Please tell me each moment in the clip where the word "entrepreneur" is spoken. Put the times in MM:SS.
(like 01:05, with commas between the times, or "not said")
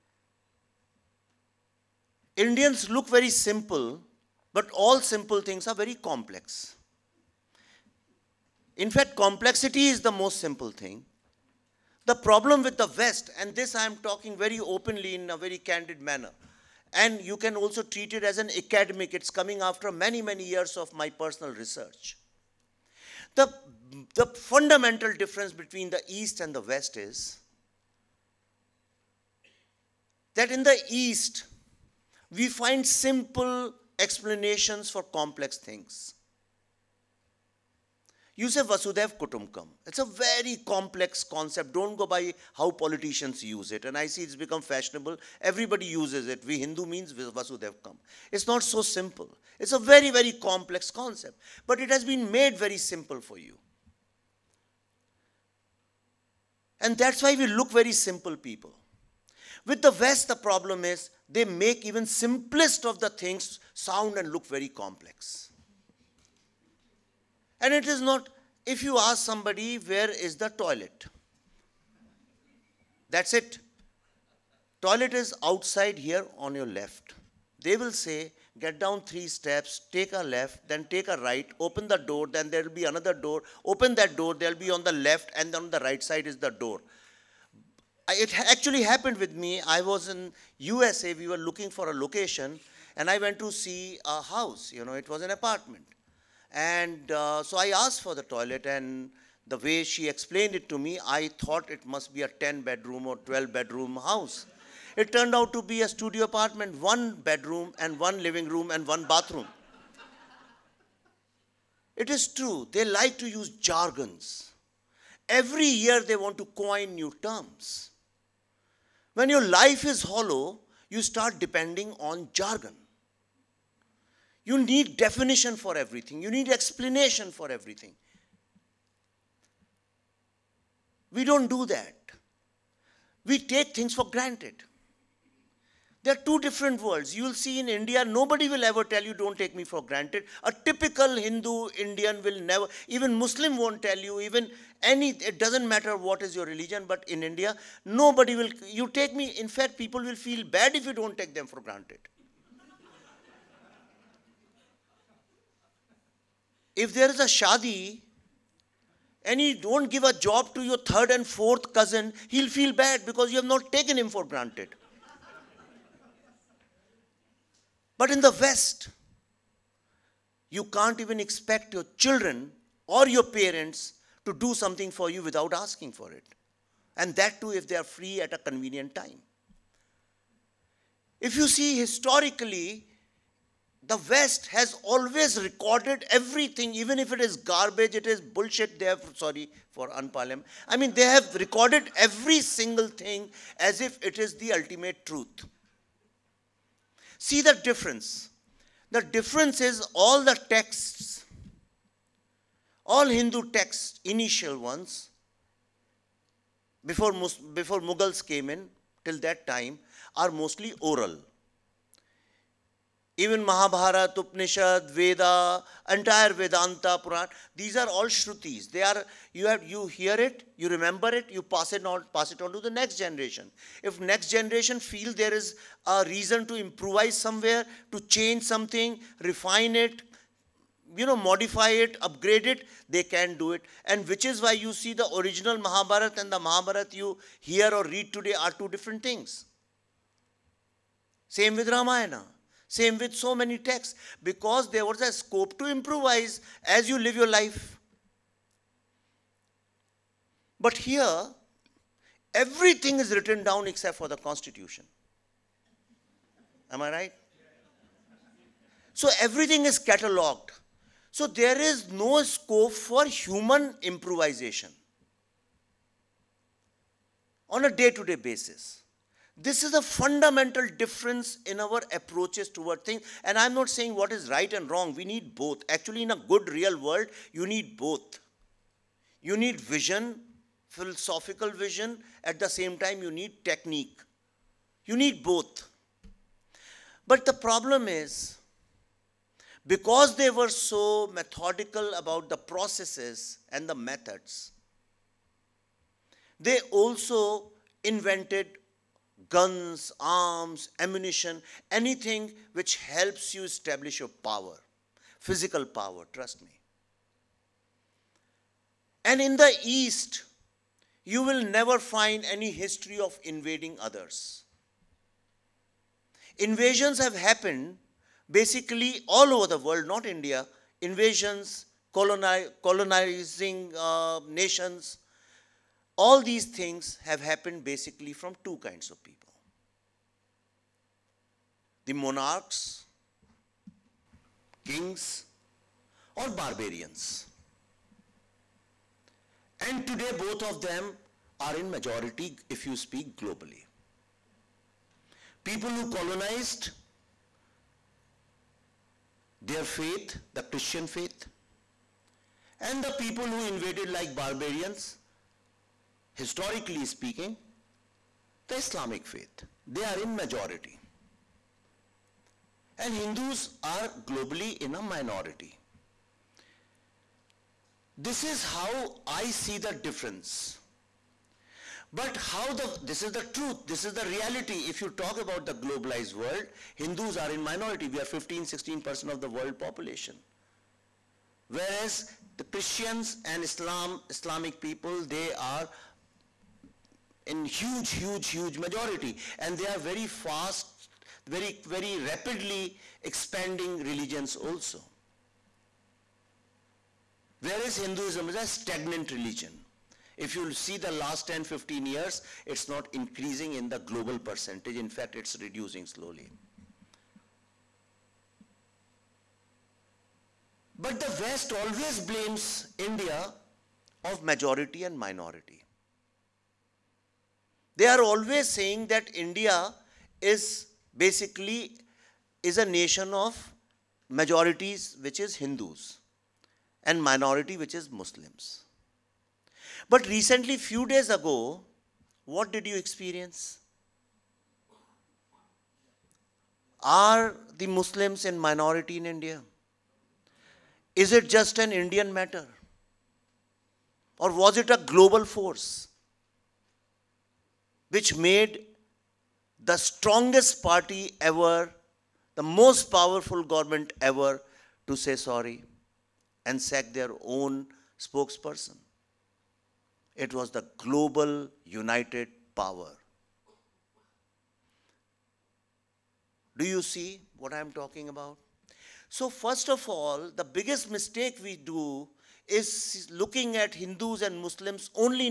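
not said.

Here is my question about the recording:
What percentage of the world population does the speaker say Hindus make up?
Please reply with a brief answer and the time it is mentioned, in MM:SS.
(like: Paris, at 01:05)
15-16%, at 06:18.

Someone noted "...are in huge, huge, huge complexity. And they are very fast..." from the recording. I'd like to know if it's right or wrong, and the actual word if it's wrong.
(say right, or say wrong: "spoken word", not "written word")
wrong: "majority", not "complexity".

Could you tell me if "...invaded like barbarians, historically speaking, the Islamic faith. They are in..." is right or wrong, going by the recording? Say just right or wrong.
right.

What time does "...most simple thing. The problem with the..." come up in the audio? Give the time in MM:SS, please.
00:10.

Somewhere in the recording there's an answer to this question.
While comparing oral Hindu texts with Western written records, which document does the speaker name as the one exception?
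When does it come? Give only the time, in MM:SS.
04:14.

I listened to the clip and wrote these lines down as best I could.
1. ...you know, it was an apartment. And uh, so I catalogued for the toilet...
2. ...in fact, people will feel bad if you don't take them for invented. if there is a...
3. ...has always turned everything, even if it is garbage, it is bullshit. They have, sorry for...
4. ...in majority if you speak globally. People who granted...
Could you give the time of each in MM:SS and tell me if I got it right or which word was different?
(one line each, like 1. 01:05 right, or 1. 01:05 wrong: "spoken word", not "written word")
1. 01:34 wrong: "asked", not "catalogued"
2. 02:29 wrong: "granted", not "invented"
3. 03:04 wrong: "recorded", not "turned"
4. 05:41 wrong: "colonized", not "granted".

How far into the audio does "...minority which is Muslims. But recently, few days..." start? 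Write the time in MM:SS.
07:07.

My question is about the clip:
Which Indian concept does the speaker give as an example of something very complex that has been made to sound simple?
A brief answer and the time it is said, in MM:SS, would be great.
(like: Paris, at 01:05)
Vasudhaiva Kutumbakam, at 00:38.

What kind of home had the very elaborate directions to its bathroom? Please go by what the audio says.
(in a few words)
Studio apartment.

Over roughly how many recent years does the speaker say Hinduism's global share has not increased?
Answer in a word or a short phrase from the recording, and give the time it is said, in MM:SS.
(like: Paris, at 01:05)
10-15 years, at 06:41.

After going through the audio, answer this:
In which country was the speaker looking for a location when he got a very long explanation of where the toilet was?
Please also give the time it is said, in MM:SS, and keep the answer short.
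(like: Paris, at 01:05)
USA, at 01:30.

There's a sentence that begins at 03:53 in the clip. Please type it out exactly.
And which is why you see the original Mahabharata and the Mahabharata you hear or read today are two different things.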